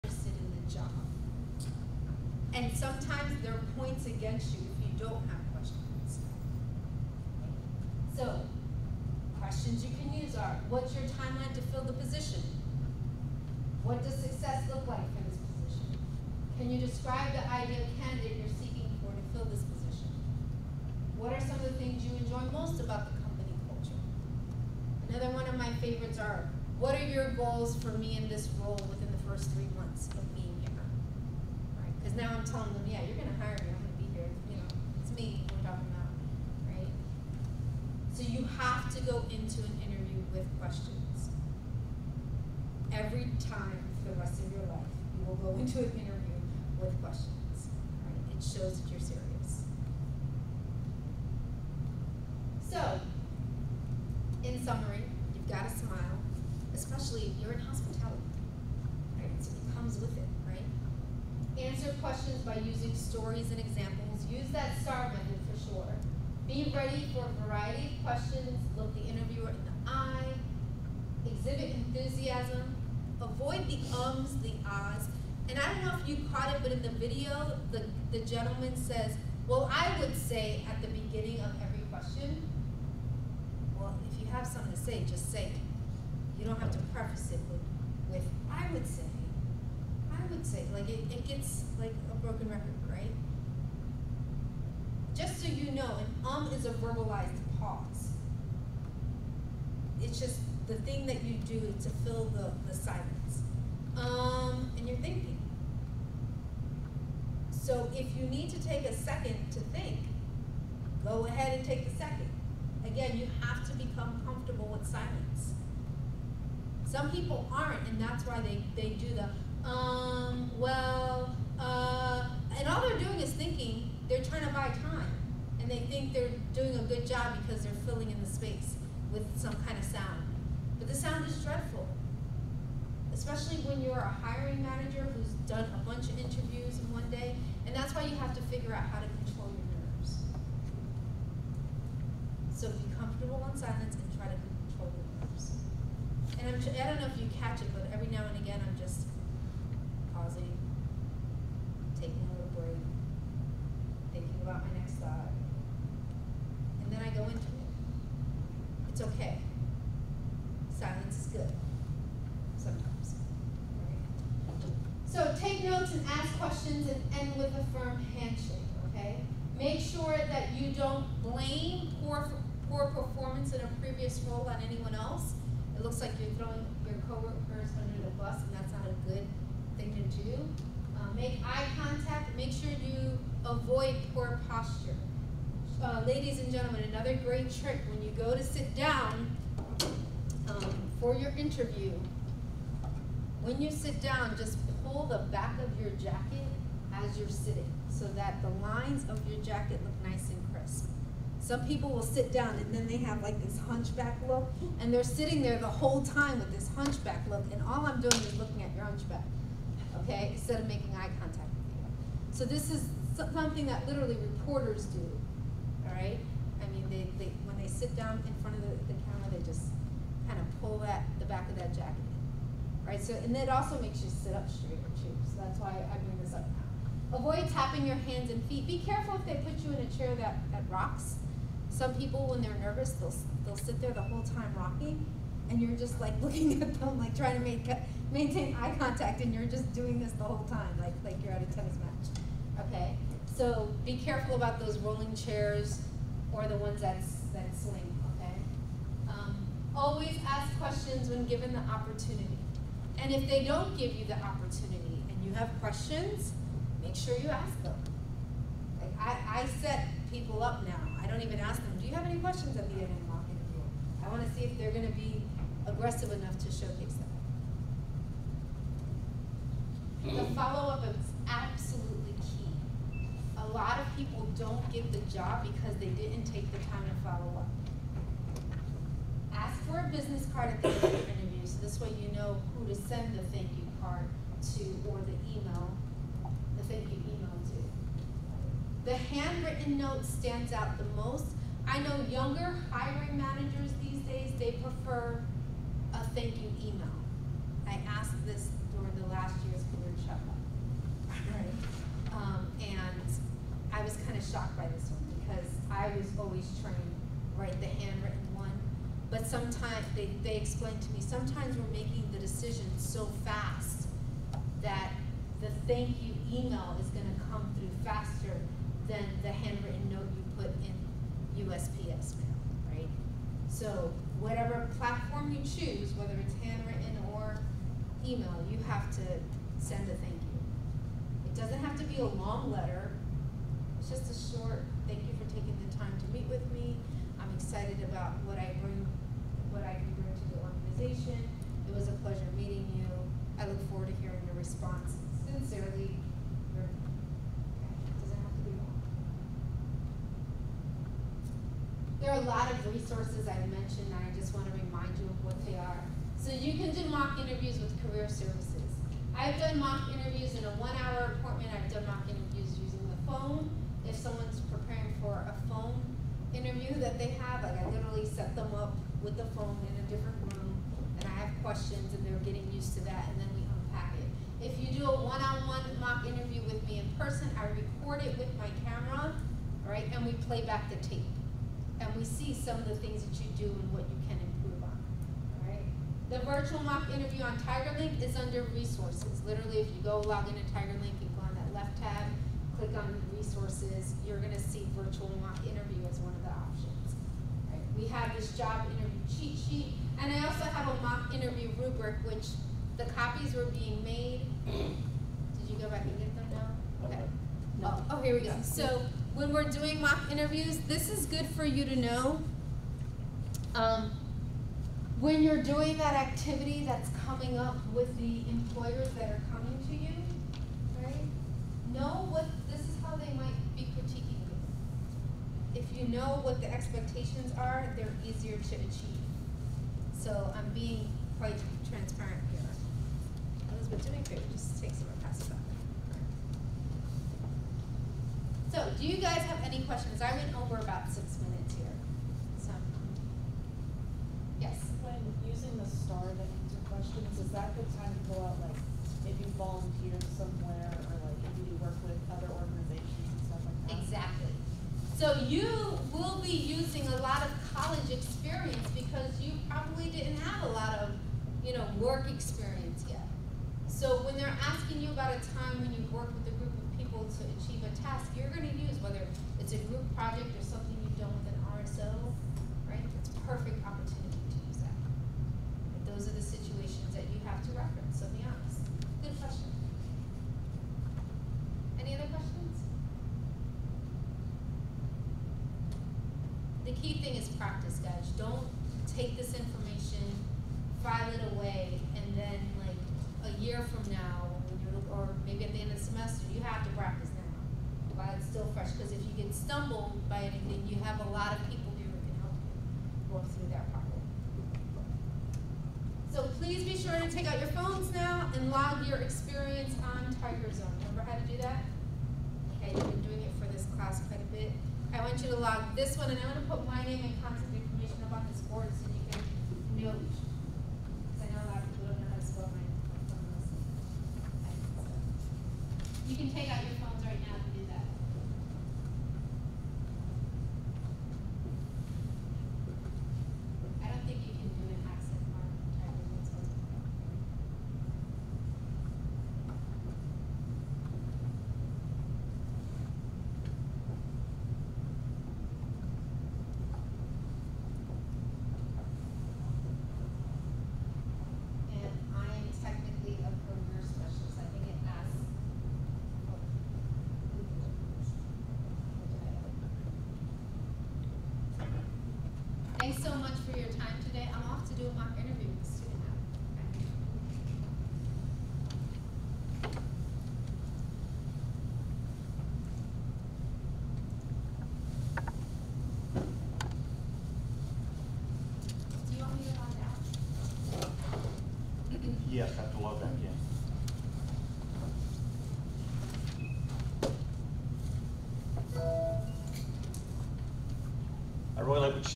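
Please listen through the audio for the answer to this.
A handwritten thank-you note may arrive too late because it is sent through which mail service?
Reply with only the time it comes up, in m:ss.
5:21.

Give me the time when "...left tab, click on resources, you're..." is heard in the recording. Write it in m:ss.
6:31.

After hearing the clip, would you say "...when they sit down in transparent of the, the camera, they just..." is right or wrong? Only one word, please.
wrong.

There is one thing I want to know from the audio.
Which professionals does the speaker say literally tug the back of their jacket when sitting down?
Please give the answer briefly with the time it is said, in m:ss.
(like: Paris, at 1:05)
reporters, at 3:34.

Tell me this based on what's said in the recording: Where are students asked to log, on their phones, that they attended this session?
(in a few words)
Tiger Zone.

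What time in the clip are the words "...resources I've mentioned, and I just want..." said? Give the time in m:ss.
5:52.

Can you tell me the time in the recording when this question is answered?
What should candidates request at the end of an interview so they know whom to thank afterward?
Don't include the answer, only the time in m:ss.
4:39.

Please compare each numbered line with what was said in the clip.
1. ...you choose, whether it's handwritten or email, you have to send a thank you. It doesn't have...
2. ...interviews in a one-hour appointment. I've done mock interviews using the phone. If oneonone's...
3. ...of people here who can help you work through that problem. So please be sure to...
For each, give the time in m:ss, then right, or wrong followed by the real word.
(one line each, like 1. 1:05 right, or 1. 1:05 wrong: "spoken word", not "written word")
1. 5:25 right
2. 5:59 wrong: "someone", not "oneonone"
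3. 8:21 right.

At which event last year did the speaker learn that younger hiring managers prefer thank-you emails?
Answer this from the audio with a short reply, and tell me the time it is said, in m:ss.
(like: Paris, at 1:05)
career shuffle, at 4:59.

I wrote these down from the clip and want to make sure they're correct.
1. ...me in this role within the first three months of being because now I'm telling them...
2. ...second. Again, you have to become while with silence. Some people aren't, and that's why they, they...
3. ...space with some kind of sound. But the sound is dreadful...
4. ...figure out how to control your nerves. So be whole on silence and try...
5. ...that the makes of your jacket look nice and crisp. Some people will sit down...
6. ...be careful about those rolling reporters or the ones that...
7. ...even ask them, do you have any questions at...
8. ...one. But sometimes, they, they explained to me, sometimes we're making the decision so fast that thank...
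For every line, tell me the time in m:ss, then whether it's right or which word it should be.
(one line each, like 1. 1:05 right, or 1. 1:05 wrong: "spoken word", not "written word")
1. 0:27 right
2. 1:51 wrong: "comfortable", not "while"
3. 2:08 right
4. 2:18 wrong: "comfortable", not "whole"
5. 3:18 wrong: "lines", not "makes"
6. 4:03 wrong: "chairs", not "reporters"
7. 4:21 right
8. 5:08 right.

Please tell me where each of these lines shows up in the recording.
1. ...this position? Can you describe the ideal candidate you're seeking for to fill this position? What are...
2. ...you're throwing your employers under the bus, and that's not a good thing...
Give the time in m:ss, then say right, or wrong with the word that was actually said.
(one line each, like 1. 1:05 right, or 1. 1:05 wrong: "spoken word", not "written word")
1. 0:15 right
2. 2:56 wrong: "coworkers", not "employers".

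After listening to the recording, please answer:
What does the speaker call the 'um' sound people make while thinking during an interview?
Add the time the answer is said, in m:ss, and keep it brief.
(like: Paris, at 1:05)
verbalized pause, at 1:36.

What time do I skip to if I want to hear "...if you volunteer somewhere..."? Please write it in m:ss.
7:29.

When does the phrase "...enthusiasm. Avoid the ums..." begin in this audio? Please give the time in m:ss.
1:11.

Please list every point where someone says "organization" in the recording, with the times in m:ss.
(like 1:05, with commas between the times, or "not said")
5:40, 7:32.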